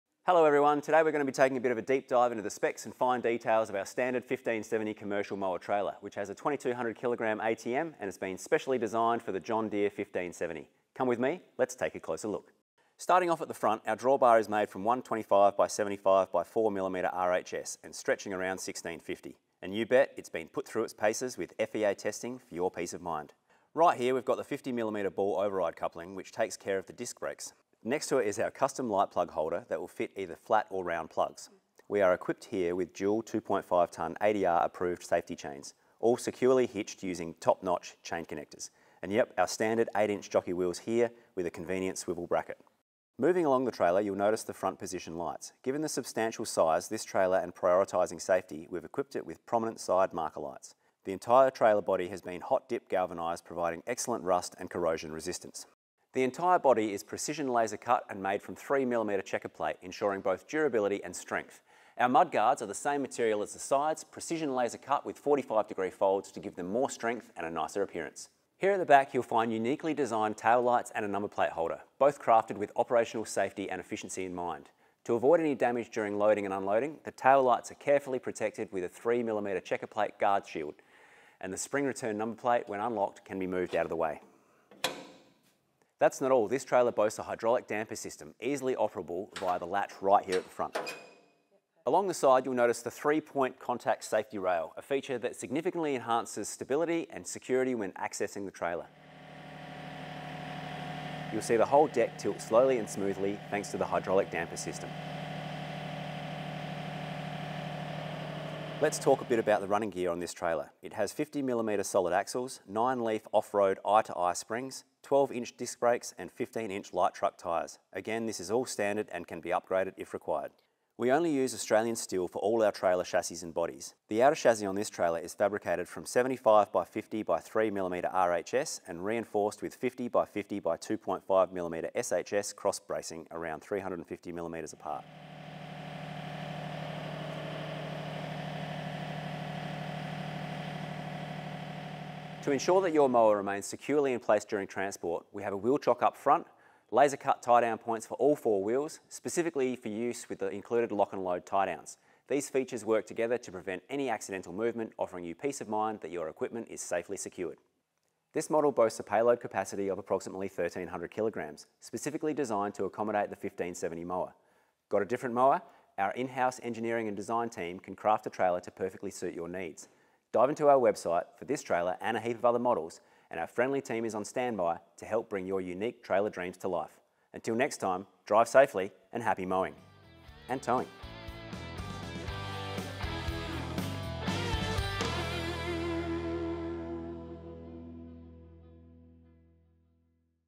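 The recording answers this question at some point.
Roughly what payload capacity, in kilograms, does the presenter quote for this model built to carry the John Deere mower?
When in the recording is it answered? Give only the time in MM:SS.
02:40.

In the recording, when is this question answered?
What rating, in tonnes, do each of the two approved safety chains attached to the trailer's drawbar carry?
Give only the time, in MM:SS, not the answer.
00:33.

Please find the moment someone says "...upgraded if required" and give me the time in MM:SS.
01:59.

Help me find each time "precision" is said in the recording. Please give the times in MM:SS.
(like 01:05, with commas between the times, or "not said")
00:57, 01:04.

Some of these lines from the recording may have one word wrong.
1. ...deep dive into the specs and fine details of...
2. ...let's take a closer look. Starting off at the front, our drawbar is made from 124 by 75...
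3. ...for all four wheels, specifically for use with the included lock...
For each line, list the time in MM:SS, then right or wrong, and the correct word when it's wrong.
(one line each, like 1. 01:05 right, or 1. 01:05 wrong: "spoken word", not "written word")
1. 00:01 right
2. 00:11 wrong: "125", not "124"
3. 02:28 right.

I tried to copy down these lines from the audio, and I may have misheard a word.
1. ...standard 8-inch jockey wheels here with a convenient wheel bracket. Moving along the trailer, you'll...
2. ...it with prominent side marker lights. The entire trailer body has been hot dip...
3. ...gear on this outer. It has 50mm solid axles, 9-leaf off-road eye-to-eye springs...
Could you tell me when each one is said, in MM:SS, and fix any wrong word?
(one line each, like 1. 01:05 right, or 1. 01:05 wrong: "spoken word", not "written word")
1. 00:39 wrong: "swivel", not "wheel"
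2. 00:49 right
3. 01:49 wrong: "trailer", not "outer".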